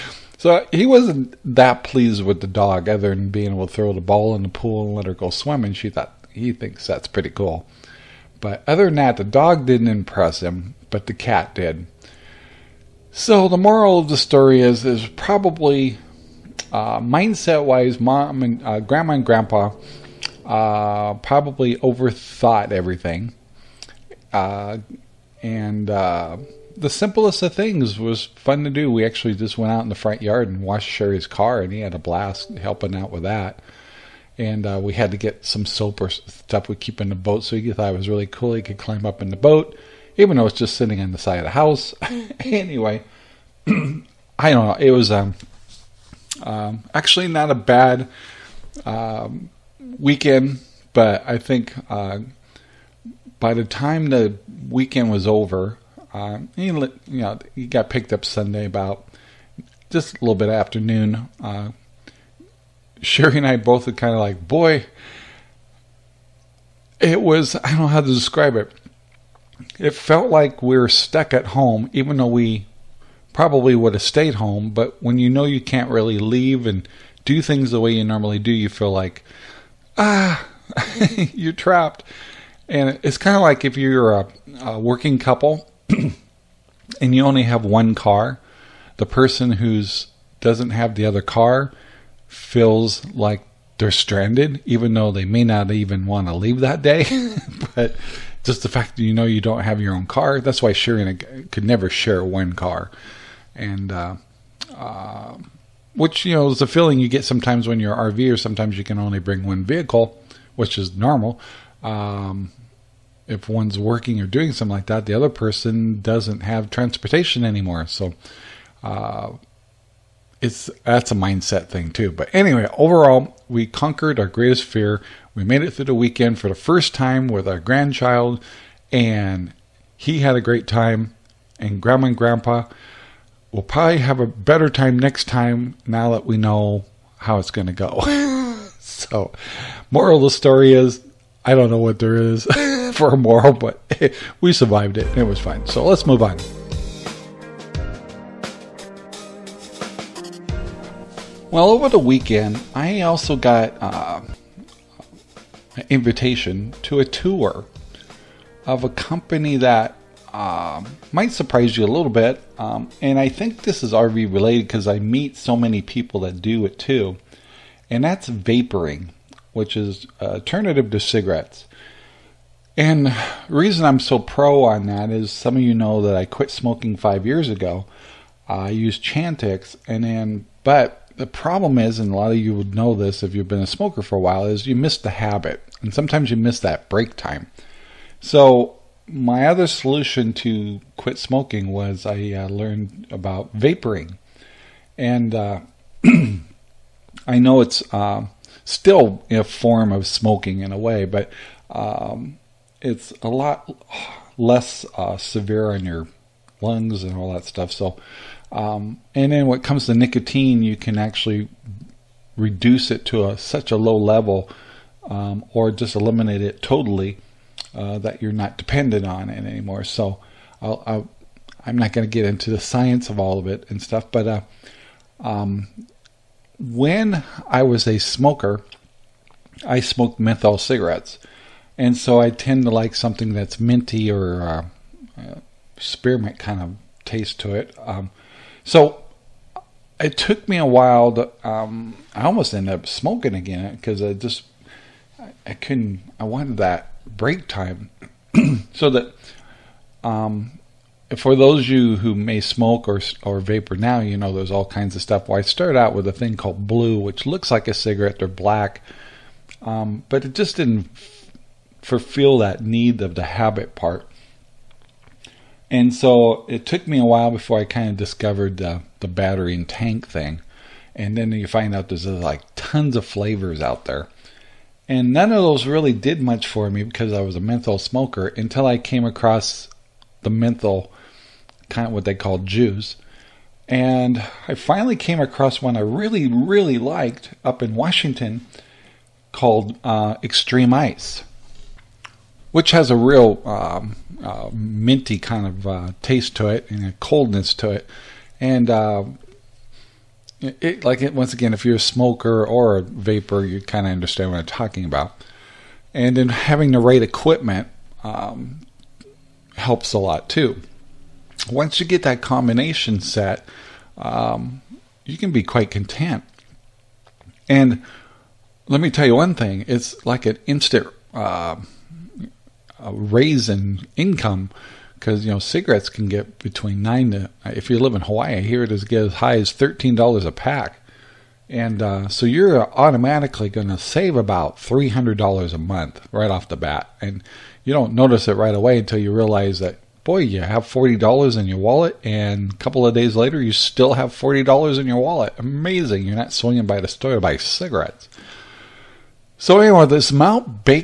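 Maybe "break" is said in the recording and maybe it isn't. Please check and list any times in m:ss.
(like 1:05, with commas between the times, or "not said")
3:06, 4:07.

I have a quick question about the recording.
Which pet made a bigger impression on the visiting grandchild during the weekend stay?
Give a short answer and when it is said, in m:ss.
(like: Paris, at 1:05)
The cat, at 0:11.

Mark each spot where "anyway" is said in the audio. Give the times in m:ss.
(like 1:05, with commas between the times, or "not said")
0:42, 2:02, 5:49.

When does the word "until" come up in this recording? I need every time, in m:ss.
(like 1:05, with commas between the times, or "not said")
4:38, 5:38.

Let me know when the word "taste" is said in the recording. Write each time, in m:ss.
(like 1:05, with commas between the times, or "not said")
3:57, 4:56.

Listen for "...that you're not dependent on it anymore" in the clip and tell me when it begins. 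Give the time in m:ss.
3:37.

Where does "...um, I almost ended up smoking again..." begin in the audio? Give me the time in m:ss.
4:01.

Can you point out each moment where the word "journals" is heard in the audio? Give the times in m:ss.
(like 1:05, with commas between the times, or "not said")
not said.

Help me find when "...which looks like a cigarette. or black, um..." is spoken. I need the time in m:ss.
4:16.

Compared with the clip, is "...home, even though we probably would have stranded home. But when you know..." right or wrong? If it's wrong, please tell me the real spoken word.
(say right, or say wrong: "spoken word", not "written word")
wrong: "stayed", not "stranded".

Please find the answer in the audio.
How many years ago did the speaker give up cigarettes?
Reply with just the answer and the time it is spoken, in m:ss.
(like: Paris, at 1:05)
5, at 2:56.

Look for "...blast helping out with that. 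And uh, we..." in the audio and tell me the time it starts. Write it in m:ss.
0:31.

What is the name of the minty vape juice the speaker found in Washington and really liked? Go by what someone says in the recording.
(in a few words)
Extreme Ice.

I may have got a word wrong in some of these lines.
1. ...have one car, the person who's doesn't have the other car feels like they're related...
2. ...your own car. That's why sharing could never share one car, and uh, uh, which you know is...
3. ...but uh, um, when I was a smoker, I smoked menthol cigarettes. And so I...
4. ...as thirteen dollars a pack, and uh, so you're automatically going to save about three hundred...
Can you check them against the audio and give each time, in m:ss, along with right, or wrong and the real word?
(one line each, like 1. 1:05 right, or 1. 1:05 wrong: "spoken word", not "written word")
1. 1:27 wrong: "stranded", not "related"
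2. 1:39 right
3. 3:44 right
4. 5:29 right.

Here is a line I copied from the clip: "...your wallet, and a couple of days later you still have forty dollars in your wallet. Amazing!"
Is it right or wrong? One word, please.
right.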